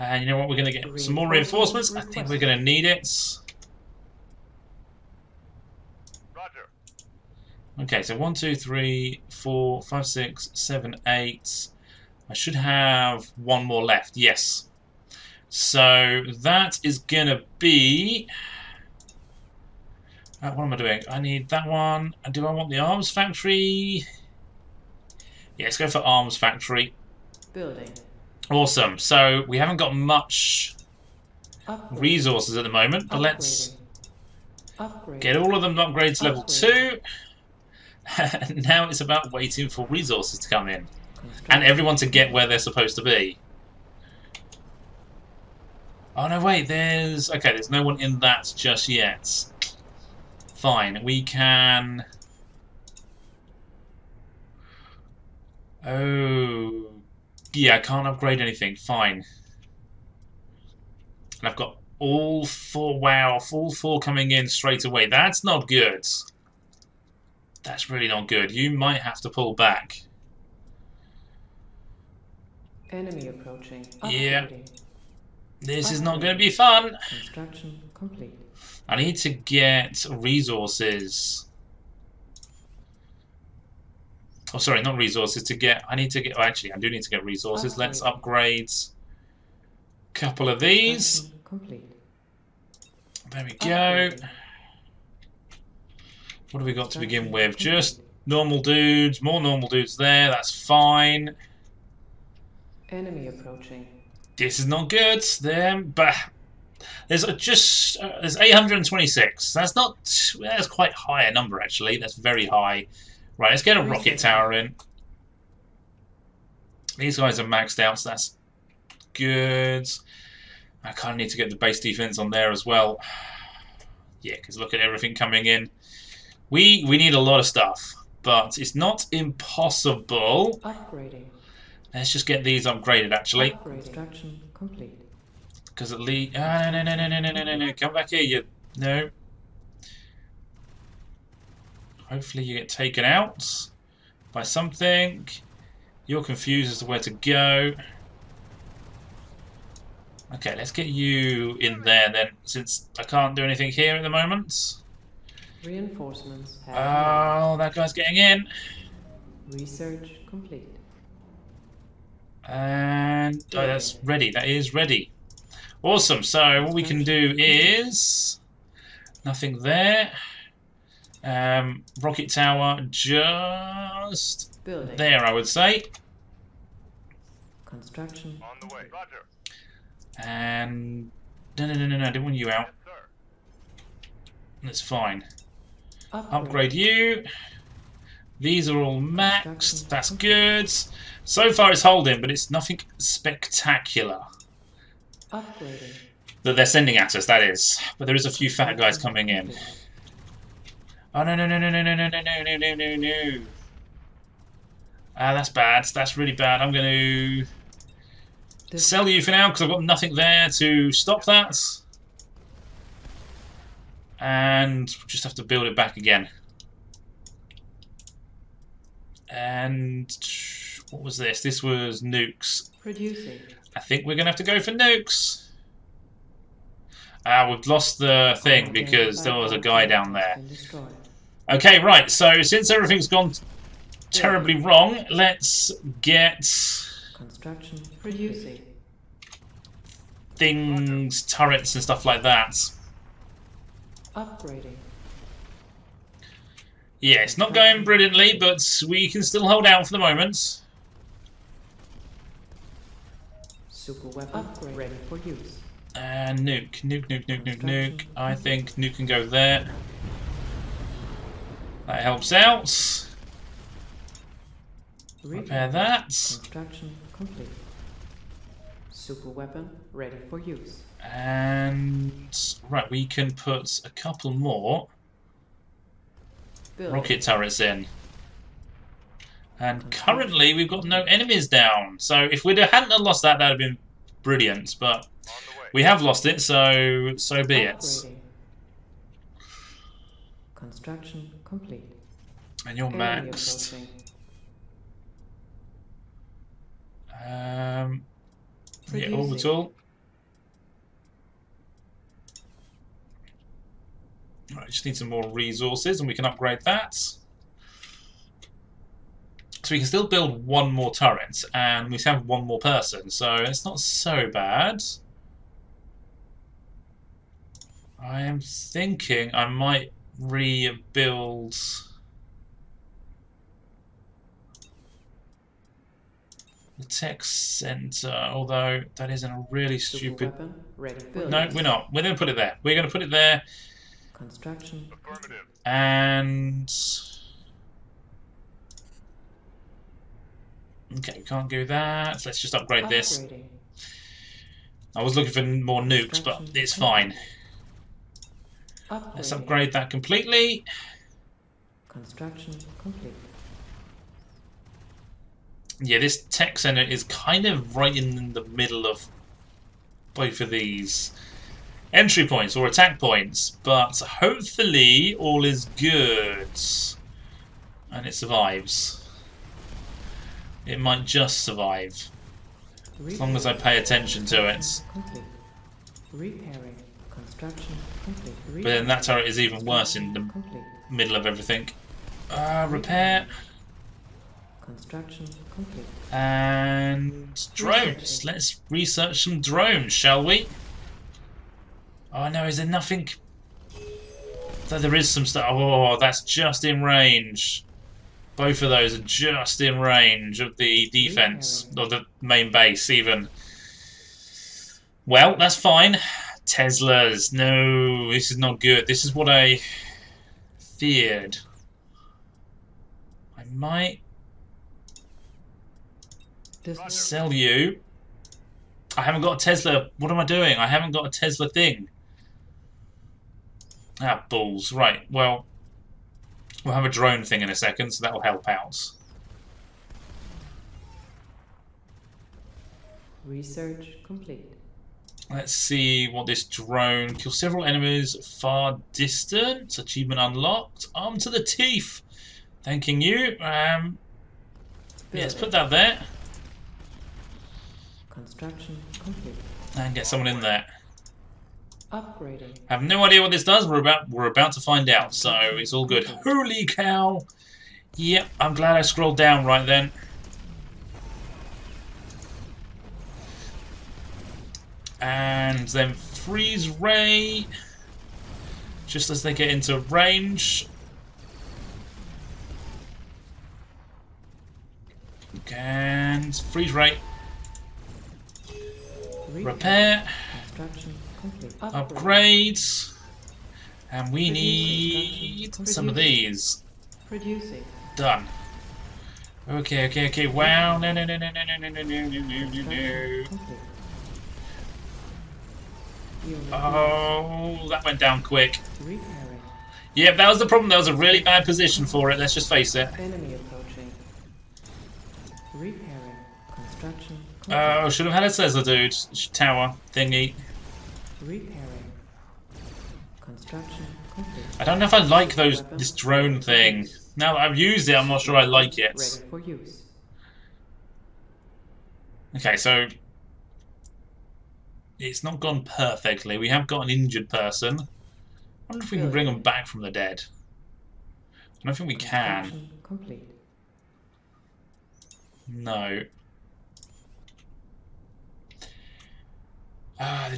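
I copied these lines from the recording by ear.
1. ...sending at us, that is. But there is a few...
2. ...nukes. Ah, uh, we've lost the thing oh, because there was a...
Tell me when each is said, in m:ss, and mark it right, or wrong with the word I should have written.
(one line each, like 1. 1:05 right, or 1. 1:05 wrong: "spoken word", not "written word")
1. 3:16 right
2. 3:44 right.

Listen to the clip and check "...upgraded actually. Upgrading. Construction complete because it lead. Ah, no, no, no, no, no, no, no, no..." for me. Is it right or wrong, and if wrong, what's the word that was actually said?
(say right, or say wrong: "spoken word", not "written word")
right.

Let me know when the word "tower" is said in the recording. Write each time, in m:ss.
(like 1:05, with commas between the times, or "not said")
1:54, 2:52, 8:29.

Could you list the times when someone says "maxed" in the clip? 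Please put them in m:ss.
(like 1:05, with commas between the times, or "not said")
1:57, 3:09, 4:52.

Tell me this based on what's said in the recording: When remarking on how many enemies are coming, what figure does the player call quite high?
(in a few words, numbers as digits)
826.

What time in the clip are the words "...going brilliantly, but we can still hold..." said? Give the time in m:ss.
4:07.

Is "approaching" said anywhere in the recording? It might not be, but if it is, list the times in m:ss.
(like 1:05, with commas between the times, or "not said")
1:13, 1:43, 8:23.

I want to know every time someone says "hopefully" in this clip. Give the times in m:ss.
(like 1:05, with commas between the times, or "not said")
2:22, 6:03.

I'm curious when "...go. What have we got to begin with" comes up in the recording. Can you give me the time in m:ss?
1:33.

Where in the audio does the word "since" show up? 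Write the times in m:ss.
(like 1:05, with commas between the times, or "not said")
2:32, 3:52.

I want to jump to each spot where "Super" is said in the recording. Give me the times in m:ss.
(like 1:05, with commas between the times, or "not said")
4:13, 4:28.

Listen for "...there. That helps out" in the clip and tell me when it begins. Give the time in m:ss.
4:19.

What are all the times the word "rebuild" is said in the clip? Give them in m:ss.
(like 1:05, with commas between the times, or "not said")
5:20.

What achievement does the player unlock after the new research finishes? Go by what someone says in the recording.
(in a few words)
Arm to the teeth.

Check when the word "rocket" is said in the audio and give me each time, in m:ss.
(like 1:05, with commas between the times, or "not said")
1:53, 2:52, 4:36.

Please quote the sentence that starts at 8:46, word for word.
We have got an injured person.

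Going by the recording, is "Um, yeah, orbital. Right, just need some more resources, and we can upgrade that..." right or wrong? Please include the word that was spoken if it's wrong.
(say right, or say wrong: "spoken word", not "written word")
right.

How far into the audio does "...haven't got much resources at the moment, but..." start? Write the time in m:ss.
0:29.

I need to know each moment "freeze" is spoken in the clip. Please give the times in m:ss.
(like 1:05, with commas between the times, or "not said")
7:45, 7:56.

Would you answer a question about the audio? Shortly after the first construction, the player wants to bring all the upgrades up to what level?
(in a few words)
level 2.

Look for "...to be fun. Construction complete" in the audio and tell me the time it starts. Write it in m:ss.
1:16.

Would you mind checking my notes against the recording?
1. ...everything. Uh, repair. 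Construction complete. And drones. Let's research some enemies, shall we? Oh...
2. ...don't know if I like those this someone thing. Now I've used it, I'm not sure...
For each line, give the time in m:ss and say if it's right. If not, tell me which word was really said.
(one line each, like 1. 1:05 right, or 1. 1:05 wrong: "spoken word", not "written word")
1. 6:21 wrong: "drones", not "enemies"
2. 8:34 wrong: "drone", not "someone".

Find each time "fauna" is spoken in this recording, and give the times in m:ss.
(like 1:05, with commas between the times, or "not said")
not said.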